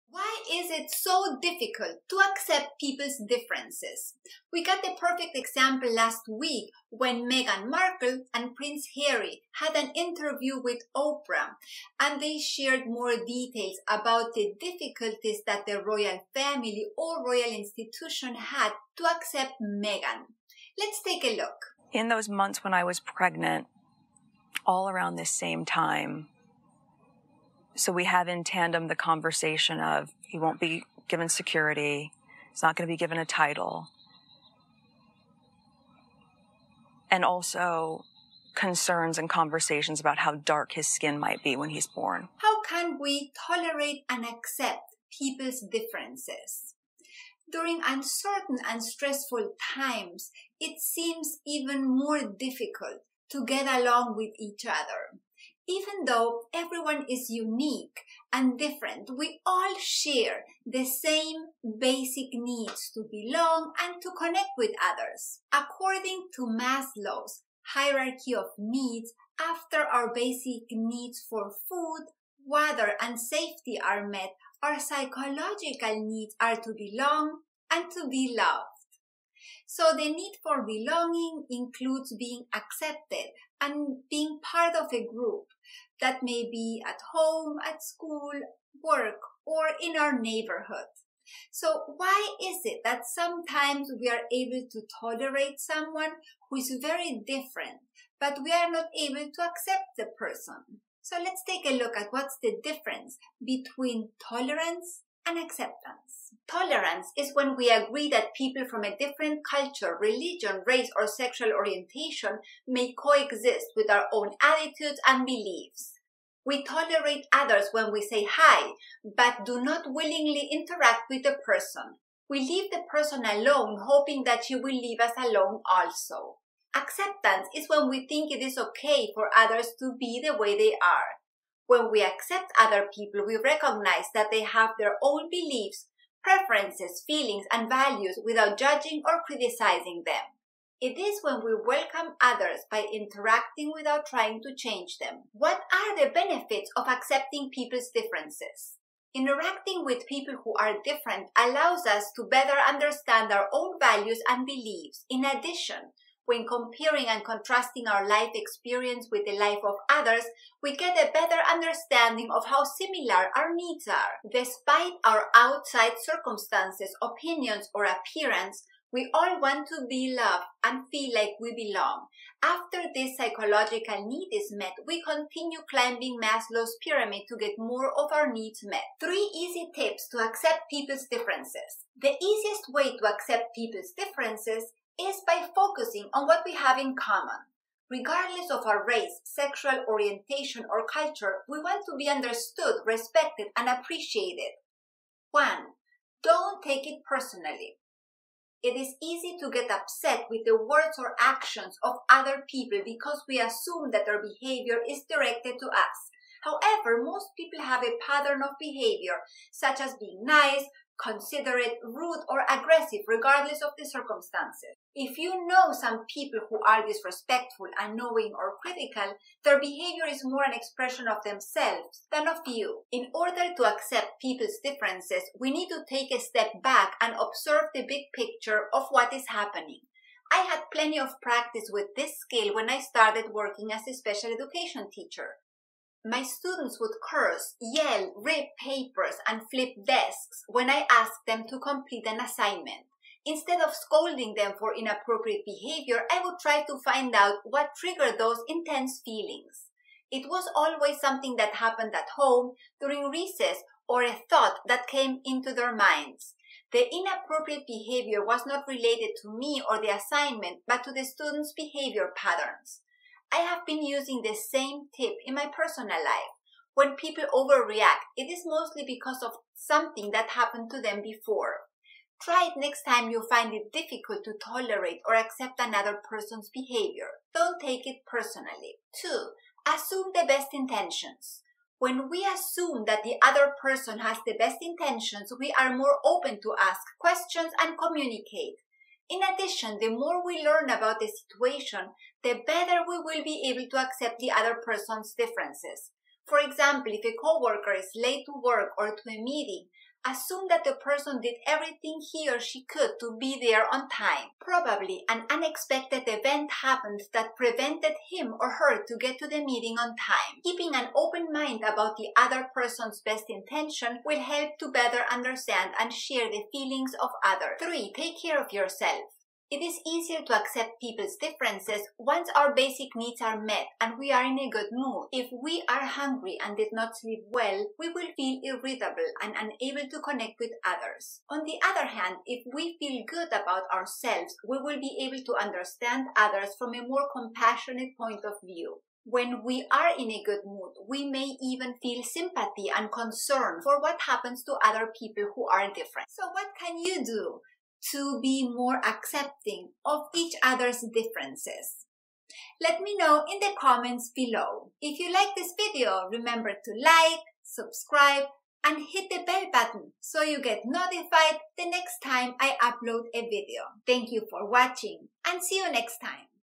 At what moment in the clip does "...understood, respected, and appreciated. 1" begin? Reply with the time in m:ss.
3:12.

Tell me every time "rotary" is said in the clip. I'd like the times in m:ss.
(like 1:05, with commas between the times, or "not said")
not said.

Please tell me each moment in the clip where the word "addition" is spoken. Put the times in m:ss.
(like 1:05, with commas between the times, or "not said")
2:35, 4:49.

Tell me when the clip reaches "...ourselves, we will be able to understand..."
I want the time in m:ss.
5:33.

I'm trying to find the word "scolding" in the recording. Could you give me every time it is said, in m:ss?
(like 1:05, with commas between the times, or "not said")
4:03.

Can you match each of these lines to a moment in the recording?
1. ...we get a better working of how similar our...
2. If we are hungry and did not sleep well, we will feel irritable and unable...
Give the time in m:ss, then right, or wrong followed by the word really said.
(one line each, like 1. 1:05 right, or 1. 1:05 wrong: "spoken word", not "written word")
1. 2:40 wrong: "understanding", not "working"
2. 5:25 right.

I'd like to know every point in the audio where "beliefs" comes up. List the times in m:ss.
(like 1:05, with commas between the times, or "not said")
1:55, 2:15, 2:34.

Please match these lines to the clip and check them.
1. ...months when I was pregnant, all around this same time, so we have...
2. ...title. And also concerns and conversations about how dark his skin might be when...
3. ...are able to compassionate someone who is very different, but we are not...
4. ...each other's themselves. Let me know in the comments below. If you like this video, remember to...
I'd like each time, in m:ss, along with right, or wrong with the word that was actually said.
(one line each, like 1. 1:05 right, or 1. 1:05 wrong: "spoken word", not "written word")
1. 0:22 right
2. 0:33 right
3. 1:34 wrong: "tolerate", not "compassionate"
4. 5:50 wrong: "differences", not "themselves".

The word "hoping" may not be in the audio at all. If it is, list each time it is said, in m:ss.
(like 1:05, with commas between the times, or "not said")
2:03.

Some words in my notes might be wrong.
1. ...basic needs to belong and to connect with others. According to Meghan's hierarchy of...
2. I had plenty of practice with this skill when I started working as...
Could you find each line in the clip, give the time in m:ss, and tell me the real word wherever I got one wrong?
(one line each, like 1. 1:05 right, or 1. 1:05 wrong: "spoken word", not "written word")
1. 1:01 wrong: "Maslow", not "Meghan"
2. 3:50 right.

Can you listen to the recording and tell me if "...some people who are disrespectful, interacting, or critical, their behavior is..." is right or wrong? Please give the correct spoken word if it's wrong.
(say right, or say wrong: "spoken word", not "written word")
wrong: "unknowing", not "interacting".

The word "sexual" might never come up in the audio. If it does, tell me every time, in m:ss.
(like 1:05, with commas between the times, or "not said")
1:51, 3:09.